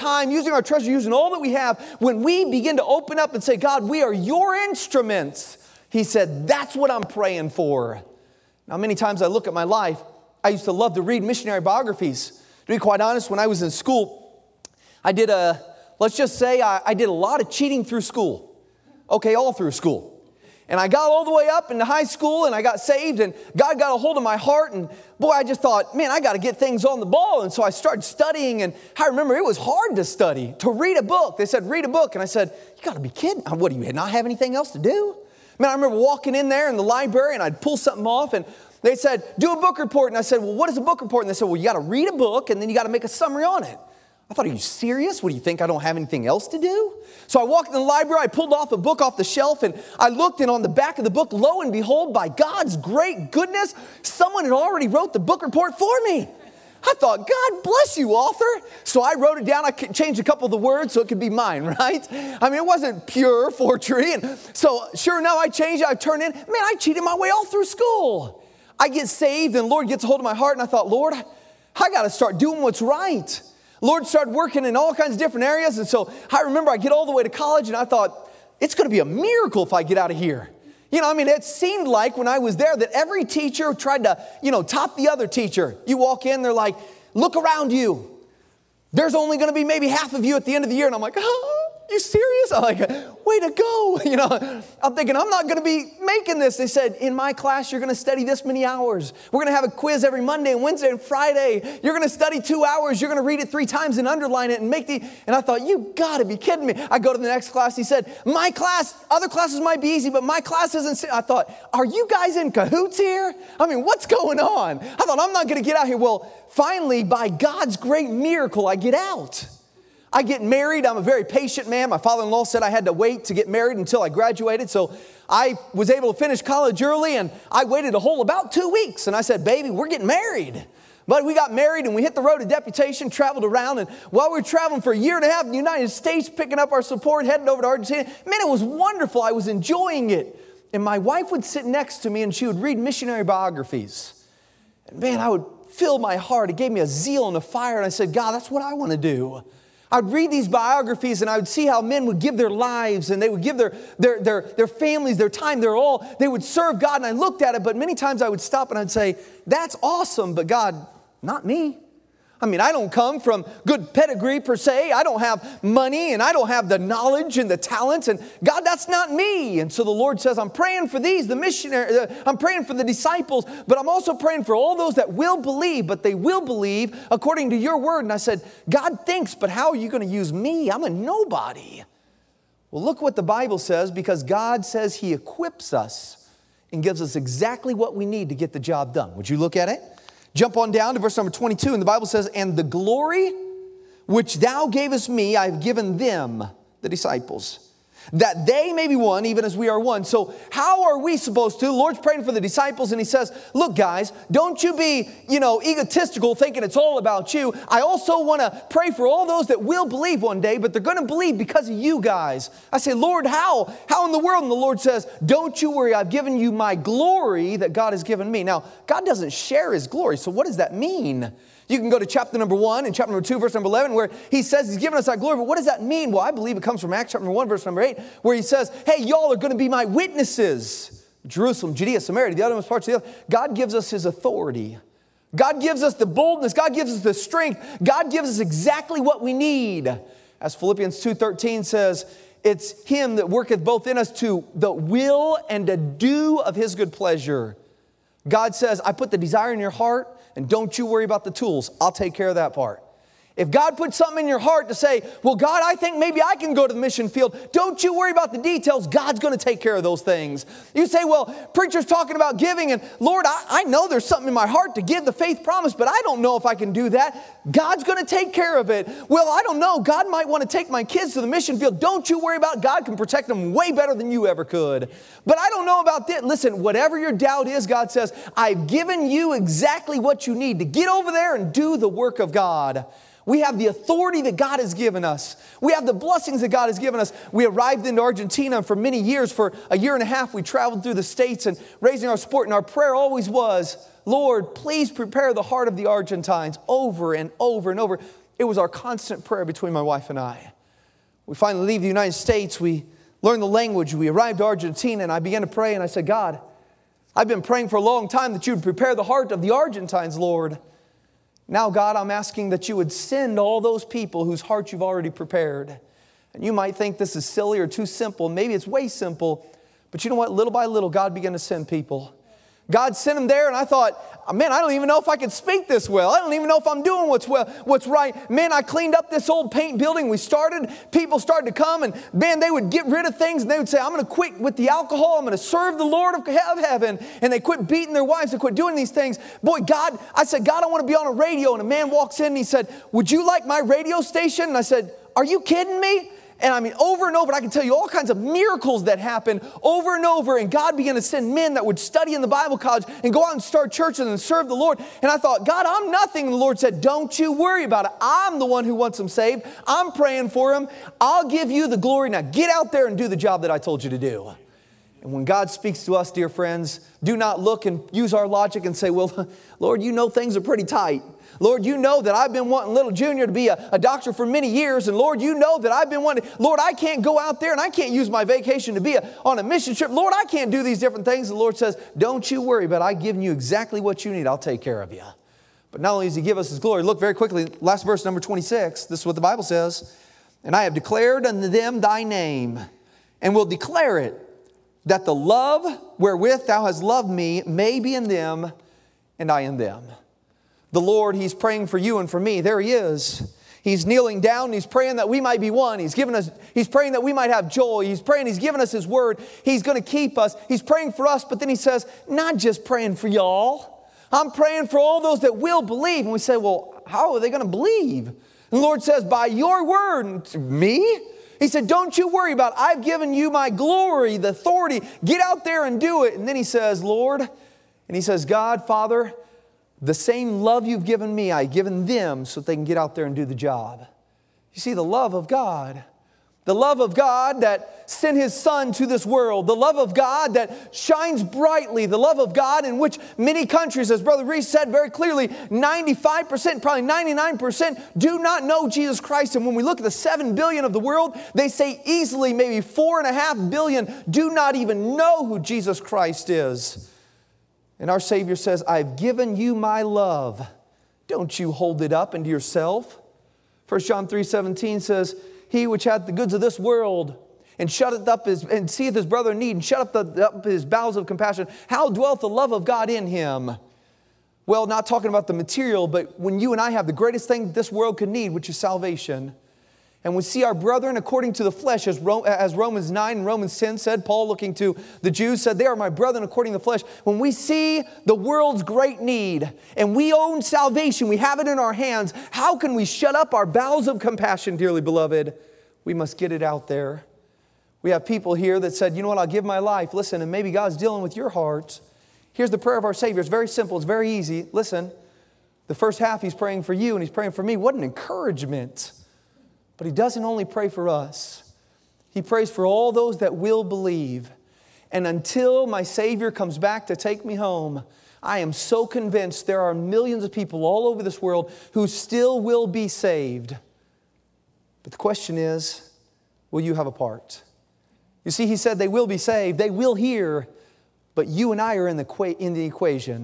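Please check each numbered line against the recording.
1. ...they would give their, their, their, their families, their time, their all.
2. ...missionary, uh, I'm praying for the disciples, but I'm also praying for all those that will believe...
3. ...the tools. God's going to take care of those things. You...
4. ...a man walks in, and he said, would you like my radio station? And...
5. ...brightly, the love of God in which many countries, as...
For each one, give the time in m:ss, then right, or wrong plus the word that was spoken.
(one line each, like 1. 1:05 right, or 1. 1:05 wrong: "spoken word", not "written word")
1. 2:33 right
2. 2:51 right
3. 4:18 wrong: "details", not "tools"
4. 5:41 right
5. 7:21 right.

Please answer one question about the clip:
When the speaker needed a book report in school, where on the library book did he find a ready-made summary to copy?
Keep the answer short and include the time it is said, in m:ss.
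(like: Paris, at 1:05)
On the back of the book, at 0:50.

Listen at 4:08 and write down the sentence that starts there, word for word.
God says, I put the desire in your heart.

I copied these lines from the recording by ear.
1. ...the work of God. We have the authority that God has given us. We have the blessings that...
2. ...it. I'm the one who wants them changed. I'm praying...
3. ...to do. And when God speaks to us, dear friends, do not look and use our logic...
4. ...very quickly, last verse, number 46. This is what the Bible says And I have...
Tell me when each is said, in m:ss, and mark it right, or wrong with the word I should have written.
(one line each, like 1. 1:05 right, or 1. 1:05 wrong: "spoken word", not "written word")
1. 4:41 right
2. 5:57 wrong: "saved", not "changed"
3. 6:03 right
4. 6:26 wrong: "26", not "46".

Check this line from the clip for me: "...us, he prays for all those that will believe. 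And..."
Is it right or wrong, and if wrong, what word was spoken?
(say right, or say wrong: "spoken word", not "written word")
right.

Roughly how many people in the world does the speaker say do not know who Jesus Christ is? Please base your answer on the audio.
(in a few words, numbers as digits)
4.5 billion.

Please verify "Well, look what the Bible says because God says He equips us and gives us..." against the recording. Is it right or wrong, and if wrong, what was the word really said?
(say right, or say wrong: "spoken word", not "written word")
right.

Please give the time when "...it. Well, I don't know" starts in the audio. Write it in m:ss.
4:28.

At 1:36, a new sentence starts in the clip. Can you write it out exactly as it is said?
They said, in my class, you're going to study this many hours.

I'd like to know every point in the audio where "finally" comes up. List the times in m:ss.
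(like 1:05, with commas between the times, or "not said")
1:56, 5:01.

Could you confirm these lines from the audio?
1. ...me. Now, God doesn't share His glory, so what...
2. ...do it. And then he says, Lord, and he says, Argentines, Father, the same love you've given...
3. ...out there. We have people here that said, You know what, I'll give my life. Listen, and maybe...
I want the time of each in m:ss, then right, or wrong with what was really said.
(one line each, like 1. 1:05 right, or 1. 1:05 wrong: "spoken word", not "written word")
1. 3:38 right
2. 7:05 wrong: "God", not "Argentines"
3. 8:16 right.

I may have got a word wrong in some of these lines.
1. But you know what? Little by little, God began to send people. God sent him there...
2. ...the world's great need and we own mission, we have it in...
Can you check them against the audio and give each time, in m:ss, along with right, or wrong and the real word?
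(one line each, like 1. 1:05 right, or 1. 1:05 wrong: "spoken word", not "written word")
1. 5:19 right
2. 8:08 wrong: "salvation", not "mission".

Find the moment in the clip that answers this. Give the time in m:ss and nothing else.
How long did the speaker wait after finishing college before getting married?
2:08.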